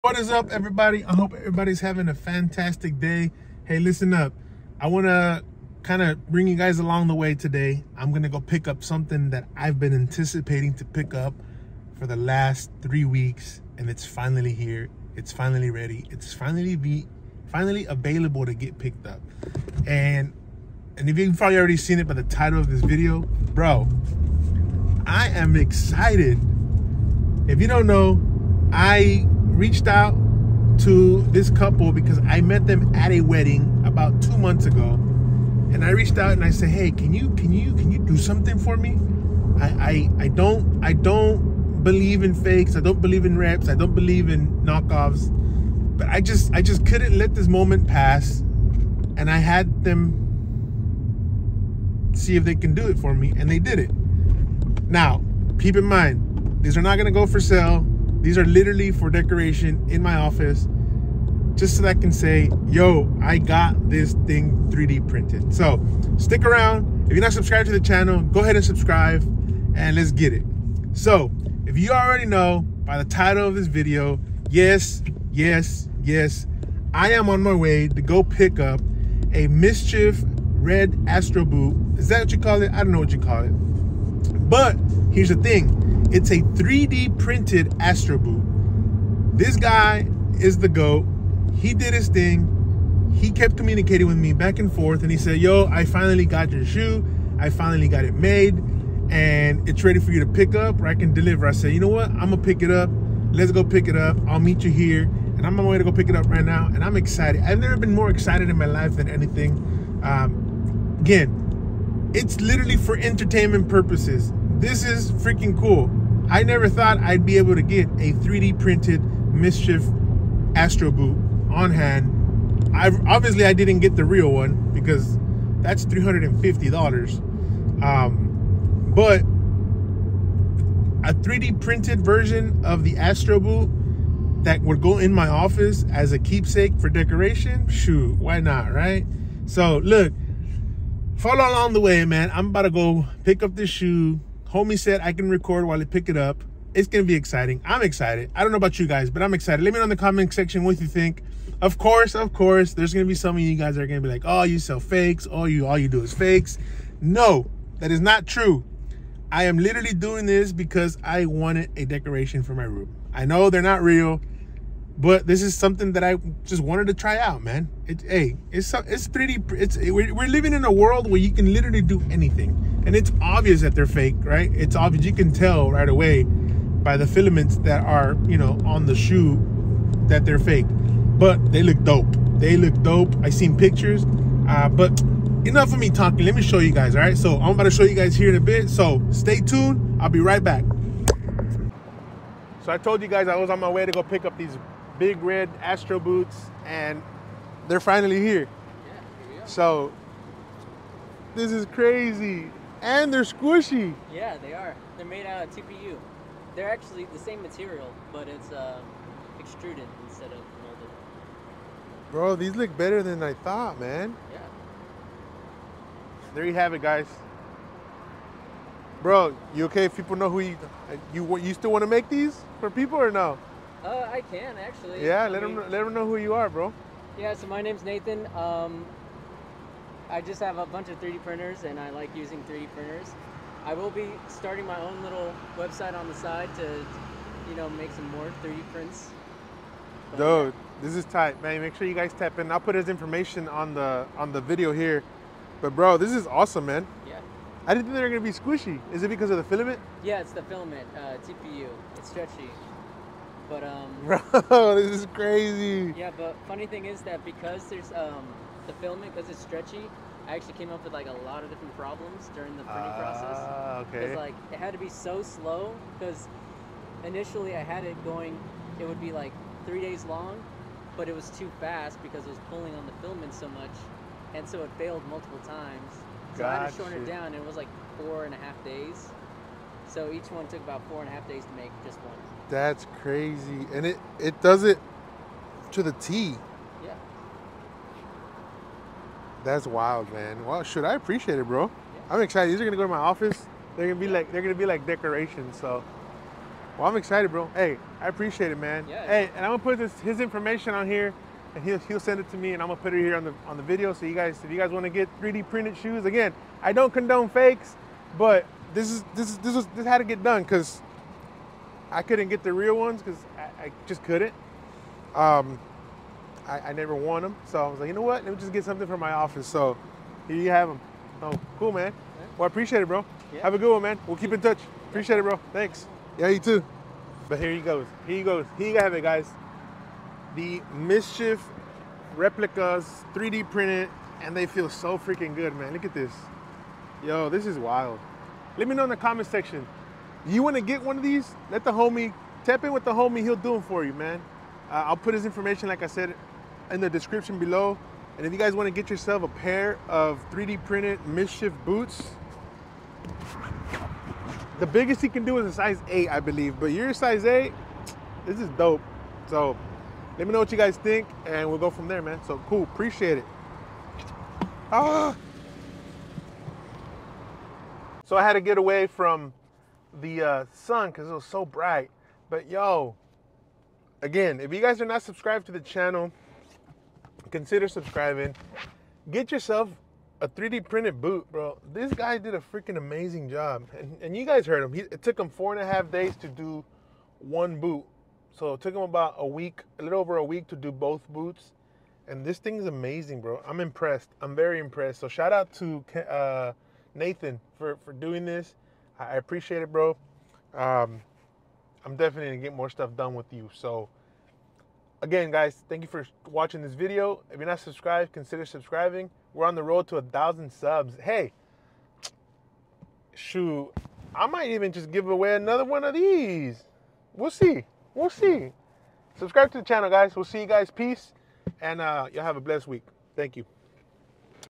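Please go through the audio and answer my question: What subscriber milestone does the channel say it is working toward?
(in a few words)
1,000 subs.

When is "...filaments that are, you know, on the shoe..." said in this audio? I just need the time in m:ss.
2:57.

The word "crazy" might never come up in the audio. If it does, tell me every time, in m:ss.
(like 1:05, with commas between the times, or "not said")
3:21, 4:15, 4:43.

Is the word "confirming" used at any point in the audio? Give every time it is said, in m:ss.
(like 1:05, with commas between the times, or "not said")
not said.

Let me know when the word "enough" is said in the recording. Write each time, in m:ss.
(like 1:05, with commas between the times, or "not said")
3:05.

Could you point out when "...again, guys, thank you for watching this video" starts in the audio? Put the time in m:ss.
6:45.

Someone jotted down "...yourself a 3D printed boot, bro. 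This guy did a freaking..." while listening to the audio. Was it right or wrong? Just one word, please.
right.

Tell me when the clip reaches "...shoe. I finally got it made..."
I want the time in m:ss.
1:36.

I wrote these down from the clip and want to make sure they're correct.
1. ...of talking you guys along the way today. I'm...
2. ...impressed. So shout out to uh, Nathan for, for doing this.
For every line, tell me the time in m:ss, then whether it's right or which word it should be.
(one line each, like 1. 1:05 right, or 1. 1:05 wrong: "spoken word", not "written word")
1. 0:06 wrong: "bring", not "talking"
2. 6:34 right.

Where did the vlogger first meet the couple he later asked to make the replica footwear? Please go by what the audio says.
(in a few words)
A wedding.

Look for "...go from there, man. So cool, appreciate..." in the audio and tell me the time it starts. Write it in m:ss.
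6:01.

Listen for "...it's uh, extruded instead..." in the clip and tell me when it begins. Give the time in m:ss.
3:28.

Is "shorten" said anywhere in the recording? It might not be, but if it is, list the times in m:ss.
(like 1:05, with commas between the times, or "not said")
4:36.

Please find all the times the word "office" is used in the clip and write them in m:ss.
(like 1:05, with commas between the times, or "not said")
1:00, 2:15, 4:52, 5:19.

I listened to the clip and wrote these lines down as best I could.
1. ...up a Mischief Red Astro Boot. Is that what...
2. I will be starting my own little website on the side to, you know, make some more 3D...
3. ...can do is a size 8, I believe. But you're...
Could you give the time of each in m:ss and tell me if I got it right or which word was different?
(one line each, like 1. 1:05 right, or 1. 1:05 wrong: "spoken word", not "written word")
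1. 1:18 right
2. 3:53 right
3. 5:55 right.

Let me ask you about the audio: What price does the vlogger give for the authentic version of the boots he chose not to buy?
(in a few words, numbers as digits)
$350.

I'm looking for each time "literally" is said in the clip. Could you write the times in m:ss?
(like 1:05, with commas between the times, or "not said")
0:58, 1:52, 2:39, 2:51.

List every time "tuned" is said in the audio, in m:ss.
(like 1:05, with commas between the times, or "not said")
3:09.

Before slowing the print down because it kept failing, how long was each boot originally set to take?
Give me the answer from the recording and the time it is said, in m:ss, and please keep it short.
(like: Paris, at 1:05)
3 days, at 4:29.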